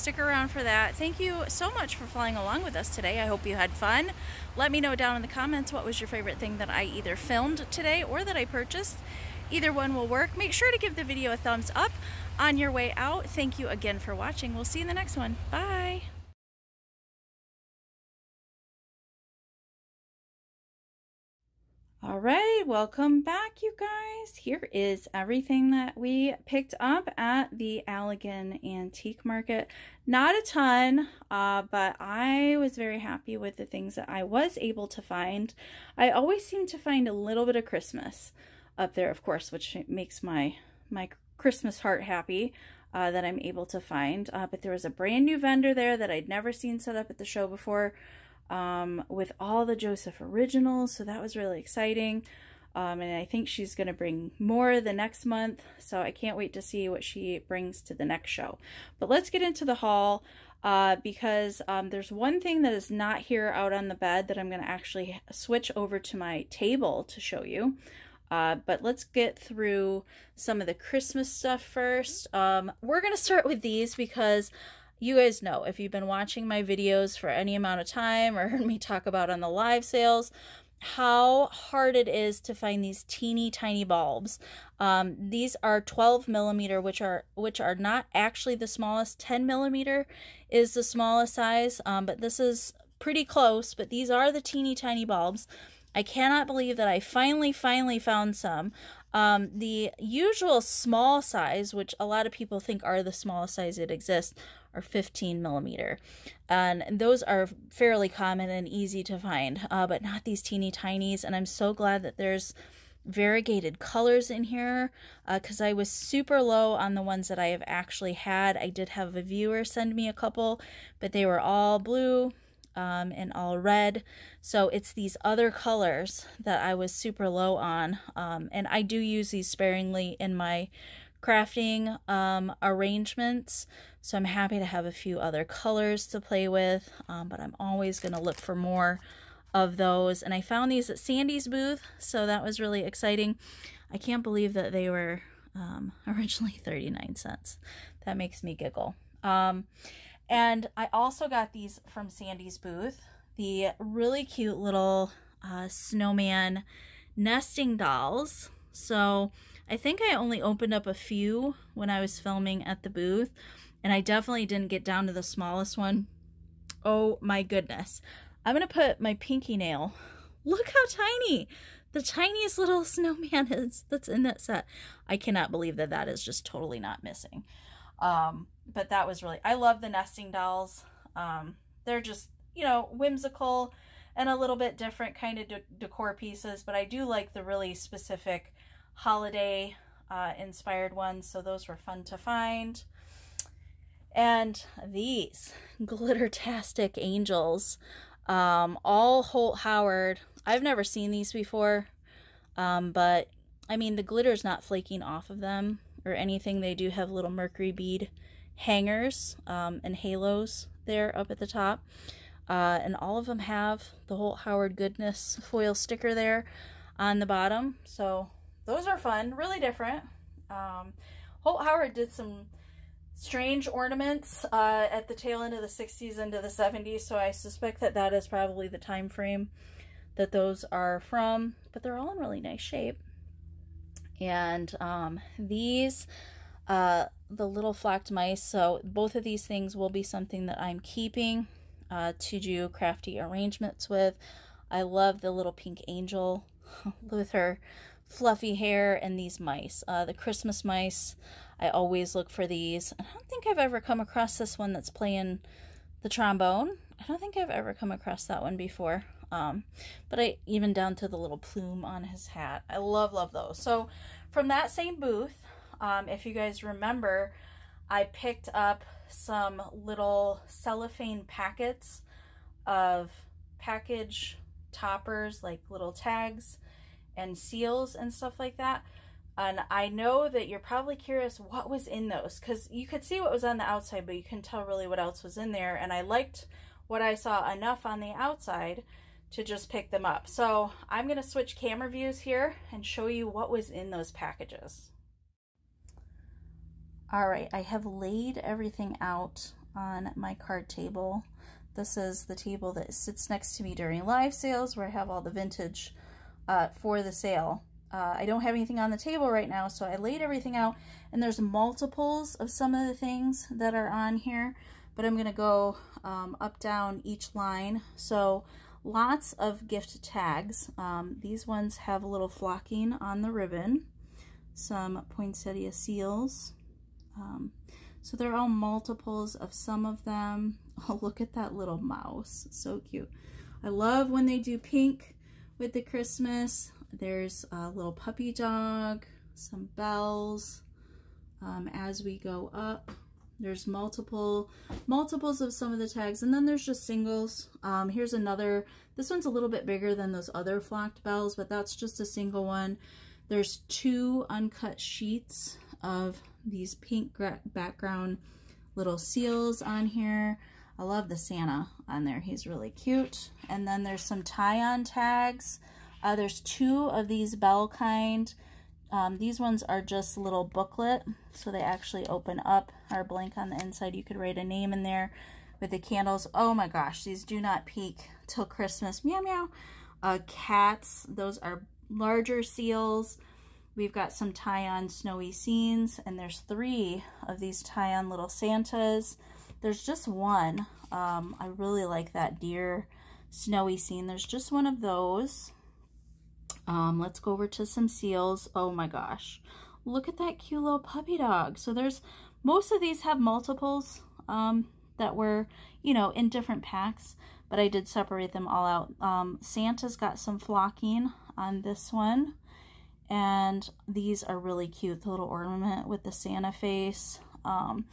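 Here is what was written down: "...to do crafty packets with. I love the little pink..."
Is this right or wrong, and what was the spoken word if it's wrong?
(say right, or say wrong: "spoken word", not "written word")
wrong: "arrangements", not "packets".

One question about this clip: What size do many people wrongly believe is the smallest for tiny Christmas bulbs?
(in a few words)
15 millimeter.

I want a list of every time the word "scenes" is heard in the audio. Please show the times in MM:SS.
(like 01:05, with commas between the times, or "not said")
06:25, 06:33.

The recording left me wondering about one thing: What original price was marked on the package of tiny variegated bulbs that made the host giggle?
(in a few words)
39 cents.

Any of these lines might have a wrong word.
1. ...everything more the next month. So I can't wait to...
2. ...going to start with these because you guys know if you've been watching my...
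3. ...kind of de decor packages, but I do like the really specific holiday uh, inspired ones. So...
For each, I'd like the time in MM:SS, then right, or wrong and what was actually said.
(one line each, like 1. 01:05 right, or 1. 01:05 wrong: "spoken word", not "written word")
1. 00:53 wrong: "bring", not "everything"
2. 01:13 right
3. 03:05 wrong: "pieces", not "packages".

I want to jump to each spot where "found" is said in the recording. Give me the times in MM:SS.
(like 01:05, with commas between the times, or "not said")
01:37, 02:20.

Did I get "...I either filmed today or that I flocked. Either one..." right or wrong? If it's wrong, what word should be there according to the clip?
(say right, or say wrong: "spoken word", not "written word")
wrong: "purchased", not "flocked".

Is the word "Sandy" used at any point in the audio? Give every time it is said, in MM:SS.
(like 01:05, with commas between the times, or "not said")
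02:20, 02:32.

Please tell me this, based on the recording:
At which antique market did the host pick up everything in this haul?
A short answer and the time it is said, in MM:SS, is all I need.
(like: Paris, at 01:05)
Allegan Antique Market, at 00:27.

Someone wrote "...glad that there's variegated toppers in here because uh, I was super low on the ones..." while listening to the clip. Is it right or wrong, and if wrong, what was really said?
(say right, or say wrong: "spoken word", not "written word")
wrong: "colors", not "toppers".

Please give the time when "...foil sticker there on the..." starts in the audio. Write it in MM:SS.
03:35.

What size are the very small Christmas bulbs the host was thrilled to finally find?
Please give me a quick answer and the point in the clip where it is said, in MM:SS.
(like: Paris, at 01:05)
12 millimeter, at 01:25.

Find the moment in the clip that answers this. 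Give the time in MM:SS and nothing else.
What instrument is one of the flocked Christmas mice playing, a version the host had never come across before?
04:16.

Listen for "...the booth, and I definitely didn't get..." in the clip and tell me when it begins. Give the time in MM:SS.
02:42.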